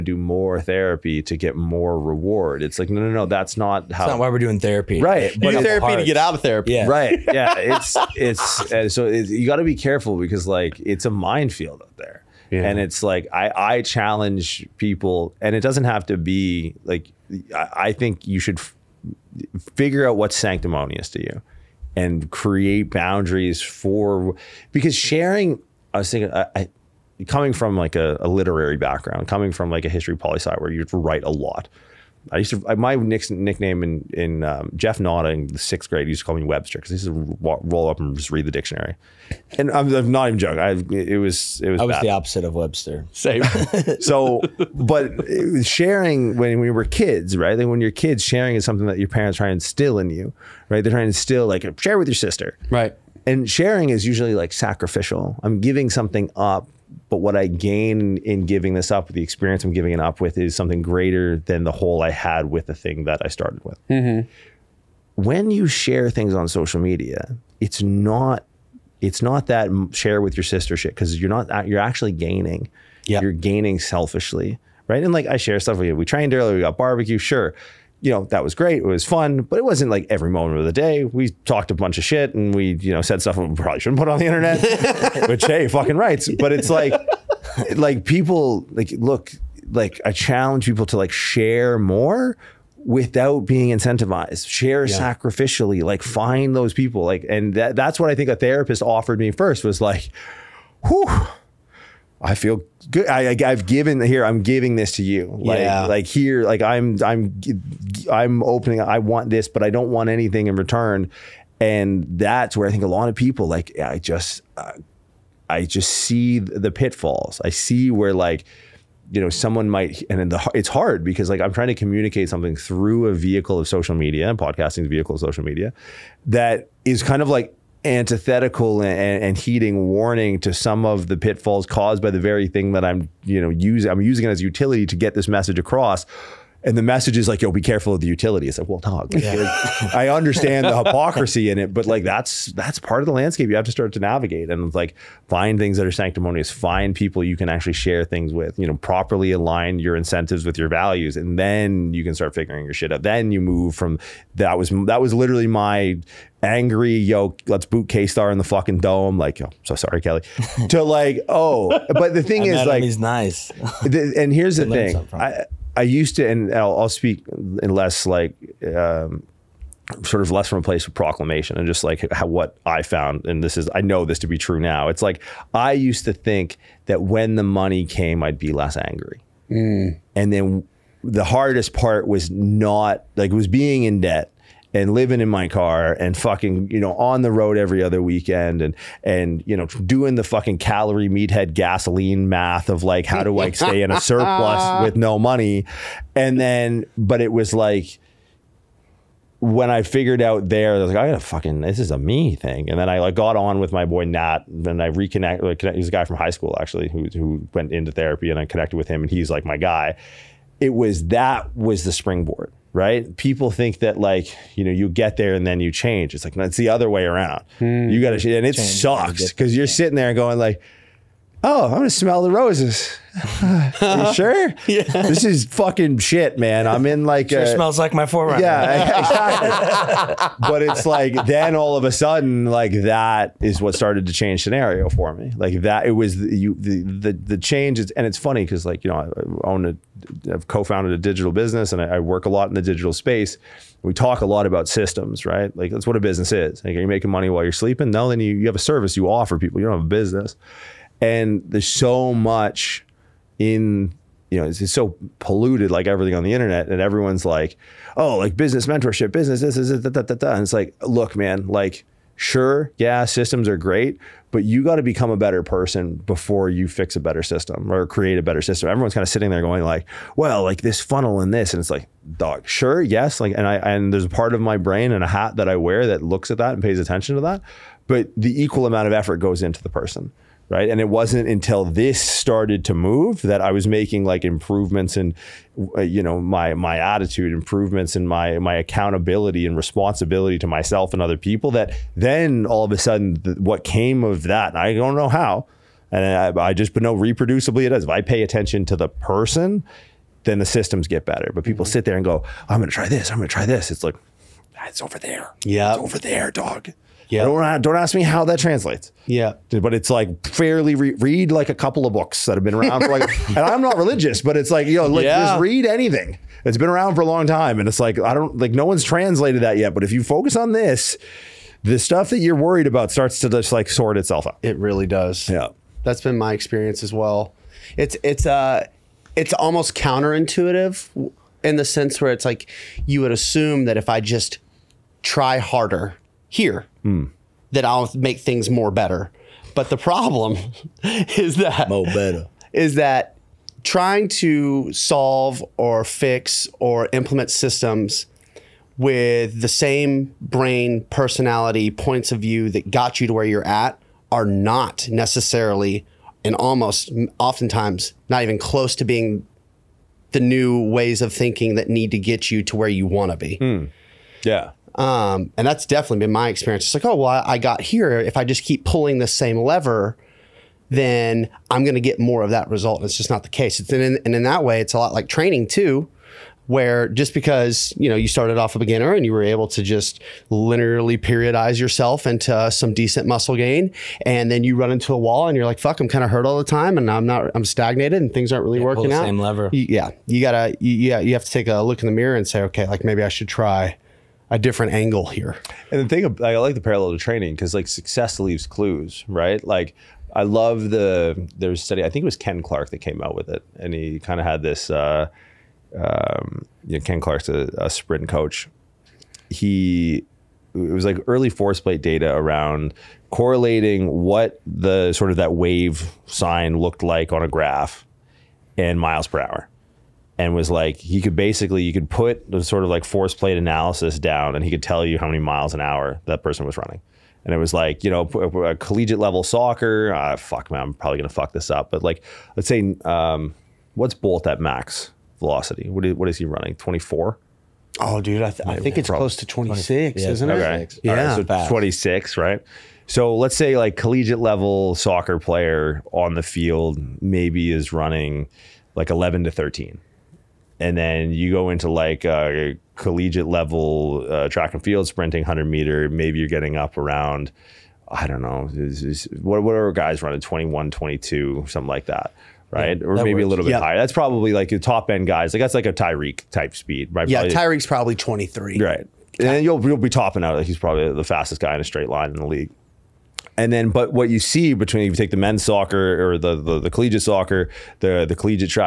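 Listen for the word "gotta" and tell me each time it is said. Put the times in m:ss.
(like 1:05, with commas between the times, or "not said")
3:21, 6:30.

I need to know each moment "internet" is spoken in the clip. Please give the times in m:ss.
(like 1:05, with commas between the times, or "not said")
1:24, 4:16.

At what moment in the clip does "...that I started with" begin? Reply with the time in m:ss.
1:03.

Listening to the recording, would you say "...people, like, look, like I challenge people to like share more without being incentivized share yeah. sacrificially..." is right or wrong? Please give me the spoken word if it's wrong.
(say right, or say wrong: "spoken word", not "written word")
right.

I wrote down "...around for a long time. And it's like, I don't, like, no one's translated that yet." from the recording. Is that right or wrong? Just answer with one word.
right.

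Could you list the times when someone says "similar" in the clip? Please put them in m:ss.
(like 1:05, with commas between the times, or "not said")
not said.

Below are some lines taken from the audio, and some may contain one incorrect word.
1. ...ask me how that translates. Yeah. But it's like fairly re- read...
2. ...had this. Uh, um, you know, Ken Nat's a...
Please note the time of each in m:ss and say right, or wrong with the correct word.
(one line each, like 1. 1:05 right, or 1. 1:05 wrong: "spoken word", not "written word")
1. 5:07 right
2. 6:44 wrong: "Clark", not "Nat".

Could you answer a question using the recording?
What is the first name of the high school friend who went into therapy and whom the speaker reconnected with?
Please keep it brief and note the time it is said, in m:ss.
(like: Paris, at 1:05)
Nat, at 3:24.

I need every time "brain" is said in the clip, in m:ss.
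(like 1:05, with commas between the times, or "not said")
4:34, 5:50.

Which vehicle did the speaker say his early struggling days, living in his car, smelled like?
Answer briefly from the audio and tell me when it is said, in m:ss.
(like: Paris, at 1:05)
4Runner, at 3:48.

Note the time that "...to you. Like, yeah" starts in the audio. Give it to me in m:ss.
1:44.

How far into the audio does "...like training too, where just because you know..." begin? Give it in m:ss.
6:14.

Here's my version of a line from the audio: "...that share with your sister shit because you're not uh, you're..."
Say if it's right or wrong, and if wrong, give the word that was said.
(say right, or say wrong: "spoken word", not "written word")
right.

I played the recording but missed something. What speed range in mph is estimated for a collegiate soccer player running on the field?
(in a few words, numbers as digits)
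11 to 13.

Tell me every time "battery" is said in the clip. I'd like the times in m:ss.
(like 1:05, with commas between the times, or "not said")
not said.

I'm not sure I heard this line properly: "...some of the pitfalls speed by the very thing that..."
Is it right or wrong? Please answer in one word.
wrong.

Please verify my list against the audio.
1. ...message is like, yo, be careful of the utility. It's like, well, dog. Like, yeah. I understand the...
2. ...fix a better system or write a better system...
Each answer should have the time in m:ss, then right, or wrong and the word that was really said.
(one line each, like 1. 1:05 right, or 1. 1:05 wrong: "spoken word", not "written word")
1. 2:16 right
2. 4:26 wrong: "create", not "write".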